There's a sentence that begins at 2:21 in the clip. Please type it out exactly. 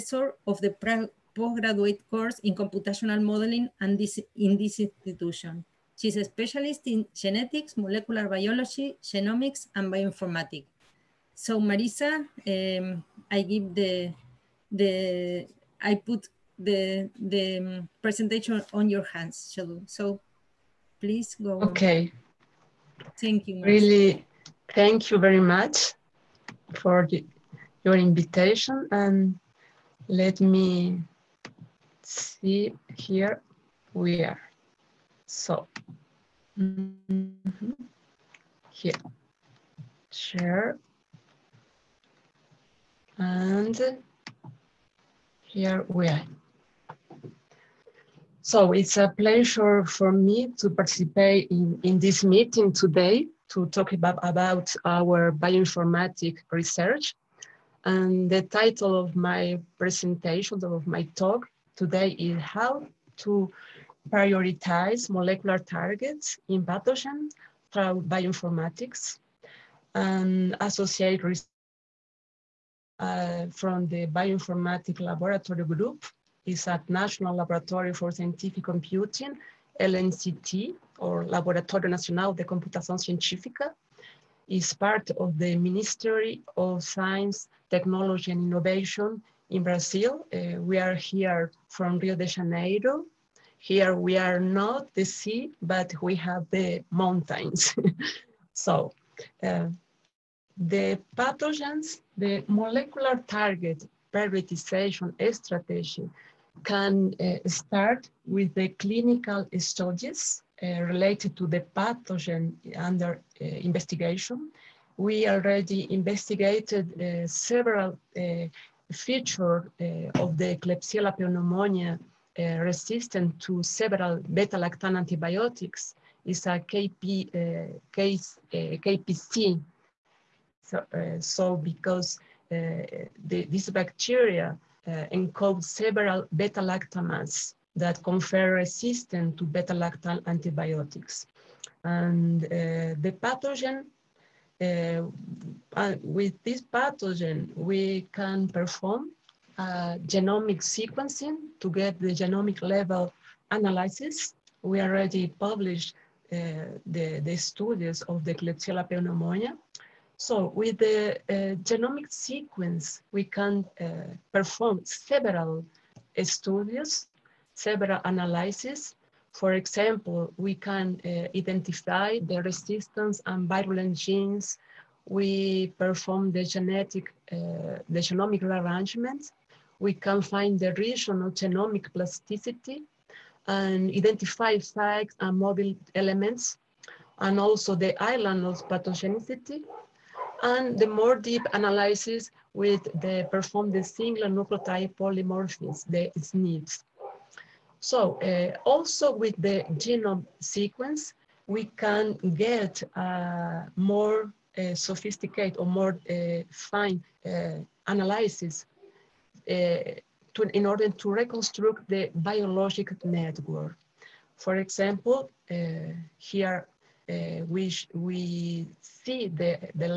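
And the pathogen uh, with this pathogen, we can perform uh, genomic sequencing to get the genomic level analysis.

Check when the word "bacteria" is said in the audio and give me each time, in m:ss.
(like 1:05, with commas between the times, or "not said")
2:13.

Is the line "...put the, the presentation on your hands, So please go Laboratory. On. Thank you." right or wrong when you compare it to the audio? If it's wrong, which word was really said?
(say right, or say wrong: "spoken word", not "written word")
wrong: "Okay", not "Laboratory".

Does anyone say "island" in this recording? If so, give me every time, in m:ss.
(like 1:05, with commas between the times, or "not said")
3:08.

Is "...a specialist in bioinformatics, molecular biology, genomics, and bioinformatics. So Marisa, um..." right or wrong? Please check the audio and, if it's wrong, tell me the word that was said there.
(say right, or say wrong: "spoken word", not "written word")
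wrong: "genetics", not "bioinformatics".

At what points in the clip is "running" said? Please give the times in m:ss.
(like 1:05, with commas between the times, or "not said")
not said.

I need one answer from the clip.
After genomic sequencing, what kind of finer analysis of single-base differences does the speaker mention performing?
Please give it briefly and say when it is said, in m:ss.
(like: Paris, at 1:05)
single nucleotide polymorphisms, at 3:13.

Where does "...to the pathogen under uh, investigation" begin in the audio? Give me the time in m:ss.
1:51.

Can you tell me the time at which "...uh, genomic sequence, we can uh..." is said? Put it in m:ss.
2:41.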